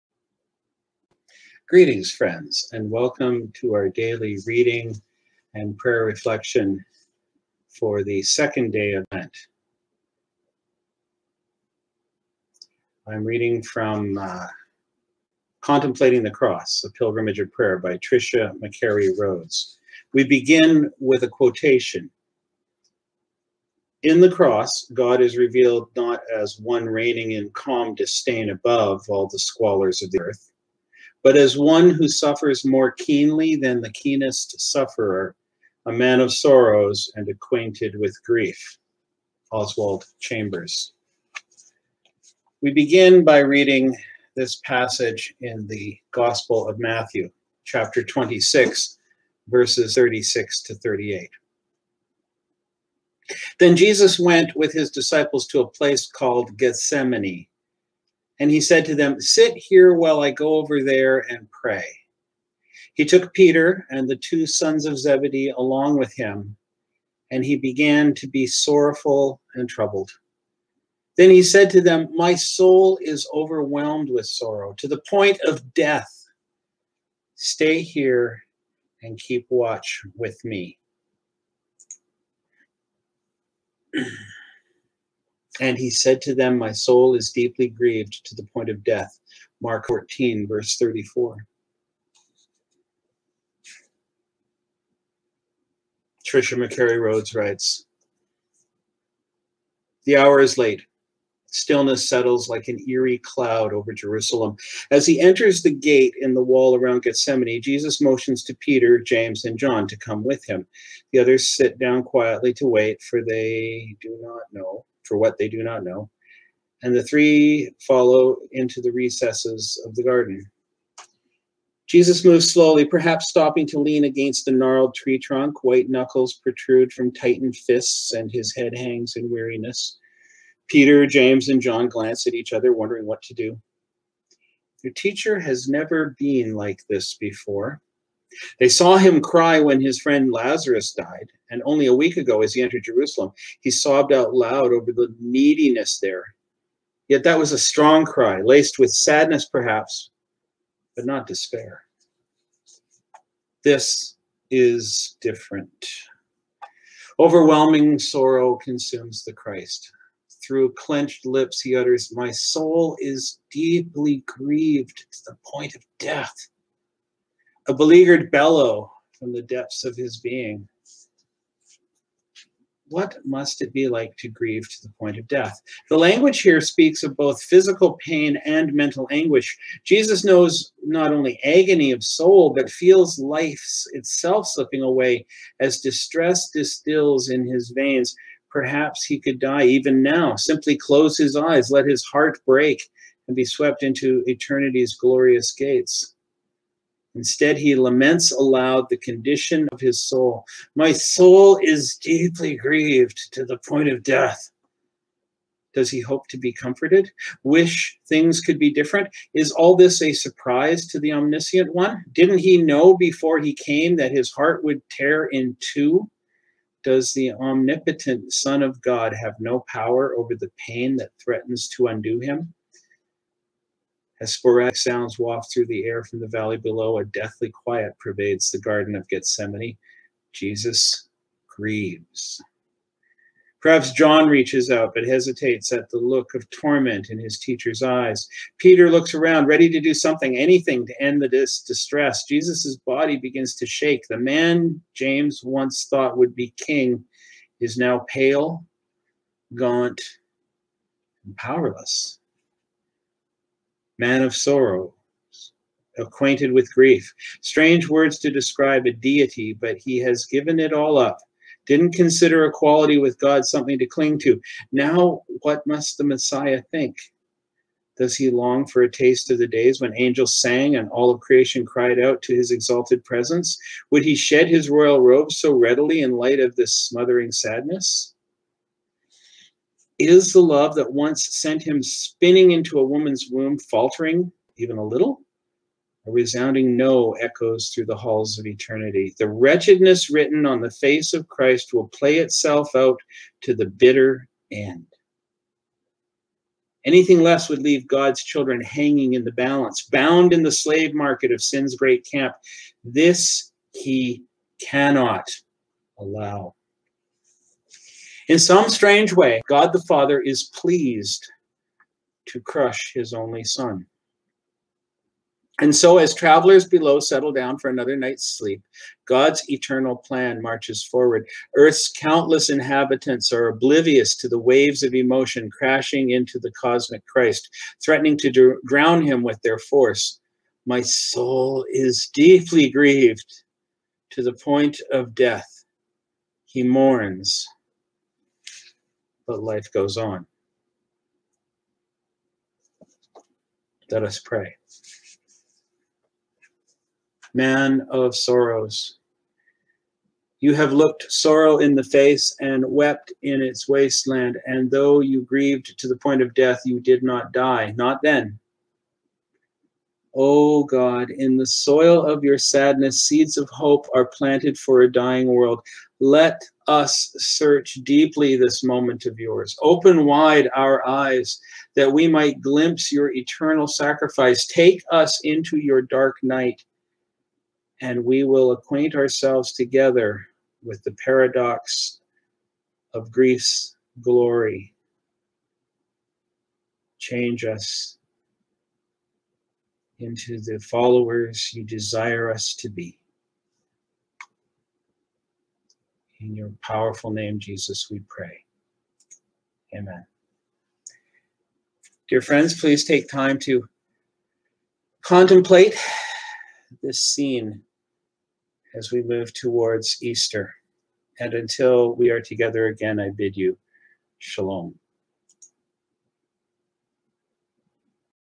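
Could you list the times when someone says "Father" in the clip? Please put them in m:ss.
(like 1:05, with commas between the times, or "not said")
5:09.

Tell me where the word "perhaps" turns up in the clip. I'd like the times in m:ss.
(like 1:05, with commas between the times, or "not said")
2:02, 2:29, 3:08, 3:53.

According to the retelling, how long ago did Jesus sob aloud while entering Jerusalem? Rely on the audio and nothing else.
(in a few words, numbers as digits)
a week ago.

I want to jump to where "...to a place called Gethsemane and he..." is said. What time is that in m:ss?
0:55.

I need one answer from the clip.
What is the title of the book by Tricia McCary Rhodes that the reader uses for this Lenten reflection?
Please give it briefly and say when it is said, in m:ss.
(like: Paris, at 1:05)
Contemplating the Cross, at 0:15.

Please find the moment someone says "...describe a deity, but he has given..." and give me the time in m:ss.
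4:18.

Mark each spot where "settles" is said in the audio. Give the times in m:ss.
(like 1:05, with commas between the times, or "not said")
1:42, 5:17.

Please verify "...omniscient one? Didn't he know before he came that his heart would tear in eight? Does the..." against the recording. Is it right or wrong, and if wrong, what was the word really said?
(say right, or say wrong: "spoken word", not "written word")
wrong: "two", not "eight".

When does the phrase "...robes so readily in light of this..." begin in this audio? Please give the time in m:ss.
4:35.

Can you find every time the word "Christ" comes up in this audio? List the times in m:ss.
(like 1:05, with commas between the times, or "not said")
2:39, 4:51, 5:27.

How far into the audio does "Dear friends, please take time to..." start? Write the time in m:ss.
6:42.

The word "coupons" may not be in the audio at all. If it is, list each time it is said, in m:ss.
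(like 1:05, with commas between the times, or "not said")
not said.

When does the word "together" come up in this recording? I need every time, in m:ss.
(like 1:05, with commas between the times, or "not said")
6:19, 6:52.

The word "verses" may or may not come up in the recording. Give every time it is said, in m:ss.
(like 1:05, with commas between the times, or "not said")
0:49, 1:30.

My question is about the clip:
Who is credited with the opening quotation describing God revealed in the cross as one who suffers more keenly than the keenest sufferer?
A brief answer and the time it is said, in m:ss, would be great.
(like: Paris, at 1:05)
Oswald Chambers, at 0:39.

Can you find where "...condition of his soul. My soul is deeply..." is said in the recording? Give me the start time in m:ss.
3:18.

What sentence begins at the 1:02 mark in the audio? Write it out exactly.
He took Peter and the two sons of Zebedee along with him, and he began to be sorrowful and troubled.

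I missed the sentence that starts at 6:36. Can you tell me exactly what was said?
In your powerful name, Jesus, we pray.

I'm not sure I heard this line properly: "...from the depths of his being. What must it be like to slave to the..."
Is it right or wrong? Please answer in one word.
wrong.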